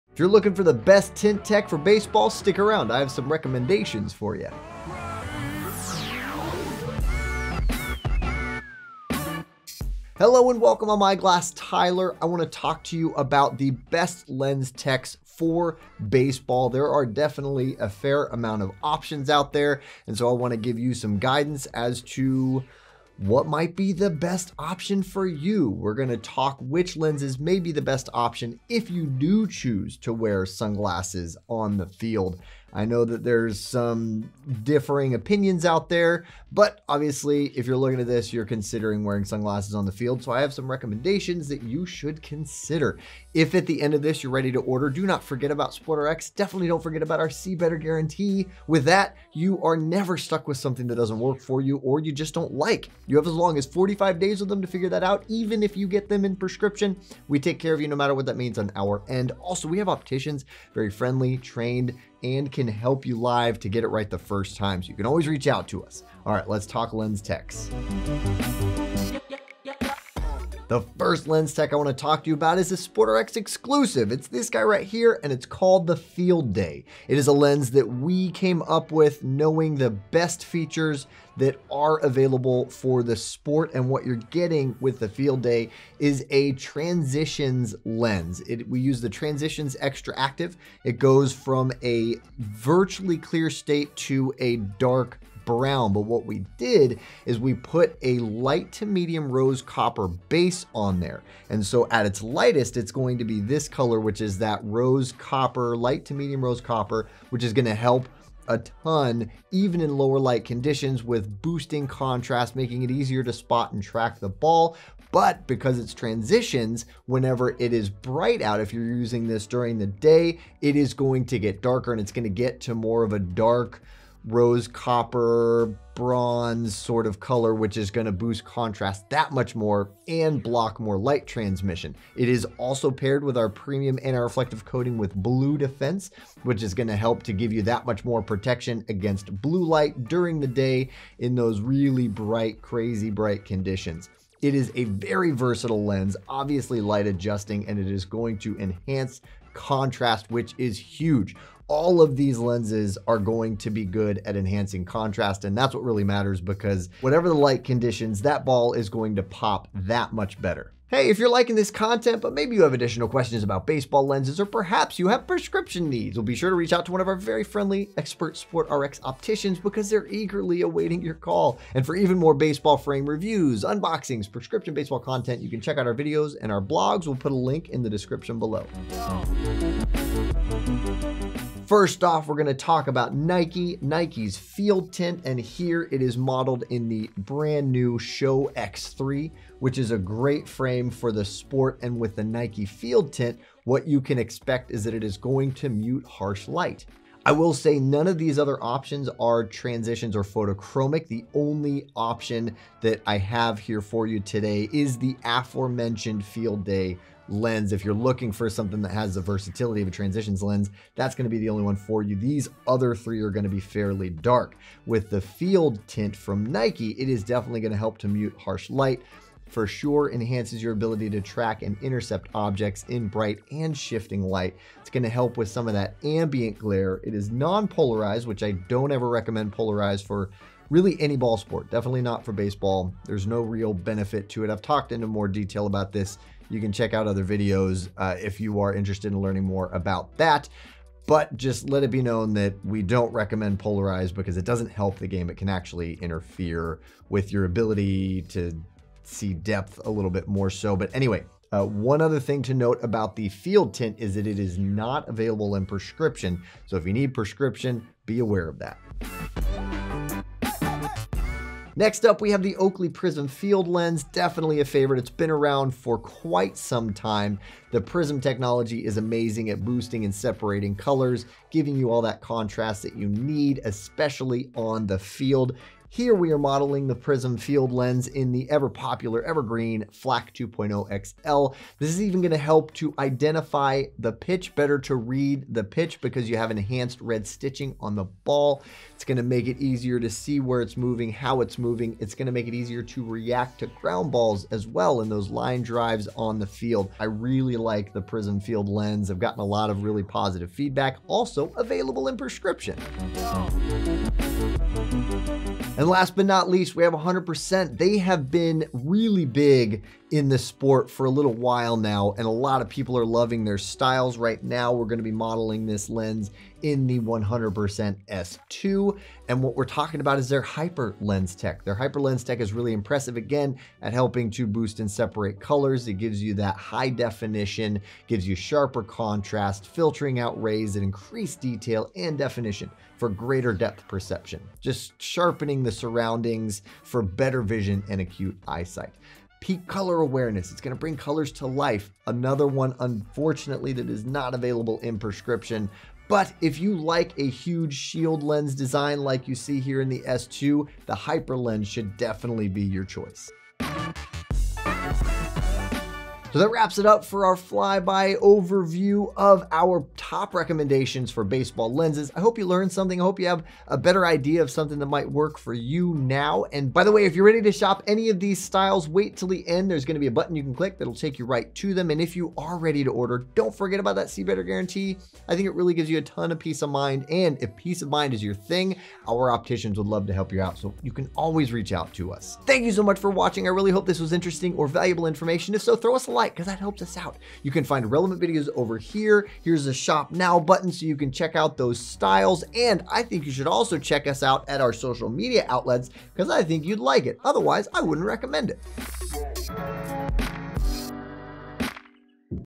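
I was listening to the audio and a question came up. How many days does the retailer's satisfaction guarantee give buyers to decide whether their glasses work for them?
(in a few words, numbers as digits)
45.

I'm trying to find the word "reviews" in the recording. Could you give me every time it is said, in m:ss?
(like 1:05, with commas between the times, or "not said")
2:53.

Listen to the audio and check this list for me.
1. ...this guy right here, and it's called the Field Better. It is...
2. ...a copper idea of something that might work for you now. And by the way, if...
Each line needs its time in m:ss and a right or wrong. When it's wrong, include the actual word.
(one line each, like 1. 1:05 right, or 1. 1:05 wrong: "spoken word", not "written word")
1. 1:14 wrong: "Day", not "Better"
2. 6:03 wrong: "better", not "copper".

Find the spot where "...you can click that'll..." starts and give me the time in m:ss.
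6:10.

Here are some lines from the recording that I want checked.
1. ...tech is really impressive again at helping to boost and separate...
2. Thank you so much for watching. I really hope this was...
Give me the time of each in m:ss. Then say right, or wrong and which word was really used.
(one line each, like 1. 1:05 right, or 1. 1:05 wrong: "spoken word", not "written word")
1. 5:22 right
2. 6:22 right.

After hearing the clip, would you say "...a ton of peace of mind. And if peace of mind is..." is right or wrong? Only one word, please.
right.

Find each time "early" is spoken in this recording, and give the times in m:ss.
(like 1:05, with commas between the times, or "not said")
not said.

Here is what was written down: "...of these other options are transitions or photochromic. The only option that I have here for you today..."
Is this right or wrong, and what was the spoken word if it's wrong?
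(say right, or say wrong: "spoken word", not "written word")
right.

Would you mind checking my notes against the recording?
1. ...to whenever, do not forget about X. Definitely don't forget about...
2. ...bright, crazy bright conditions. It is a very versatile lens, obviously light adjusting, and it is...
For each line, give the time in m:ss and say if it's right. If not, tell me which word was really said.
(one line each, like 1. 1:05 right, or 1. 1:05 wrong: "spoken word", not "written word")
1. 0:44 wrong: "order", not "whenever"
2. 2:22 right.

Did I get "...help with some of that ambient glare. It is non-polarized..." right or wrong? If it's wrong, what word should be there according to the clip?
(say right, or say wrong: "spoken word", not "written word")
right.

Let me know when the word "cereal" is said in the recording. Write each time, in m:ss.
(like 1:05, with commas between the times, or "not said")
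not said.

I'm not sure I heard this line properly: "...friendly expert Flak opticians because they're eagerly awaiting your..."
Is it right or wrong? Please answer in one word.
wrong.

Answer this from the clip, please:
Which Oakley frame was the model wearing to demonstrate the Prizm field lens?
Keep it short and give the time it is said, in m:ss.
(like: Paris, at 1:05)
Flak 2.0 XL, at 4:39.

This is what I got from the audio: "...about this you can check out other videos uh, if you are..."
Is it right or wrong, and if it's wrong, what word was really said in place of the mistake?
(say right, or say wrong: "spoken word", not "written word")
right.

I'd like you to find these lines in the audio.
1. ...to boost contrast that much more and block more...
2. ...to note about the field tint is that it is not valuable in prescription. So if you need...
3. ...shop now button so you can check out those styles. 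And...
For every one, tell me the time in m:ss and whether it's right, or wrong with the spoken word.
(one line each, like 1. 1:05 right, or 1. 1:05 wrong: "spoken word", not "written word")
1. 2:08 right
2. 4:12 wrong: "available", not "valuable"
3. 6:29 right.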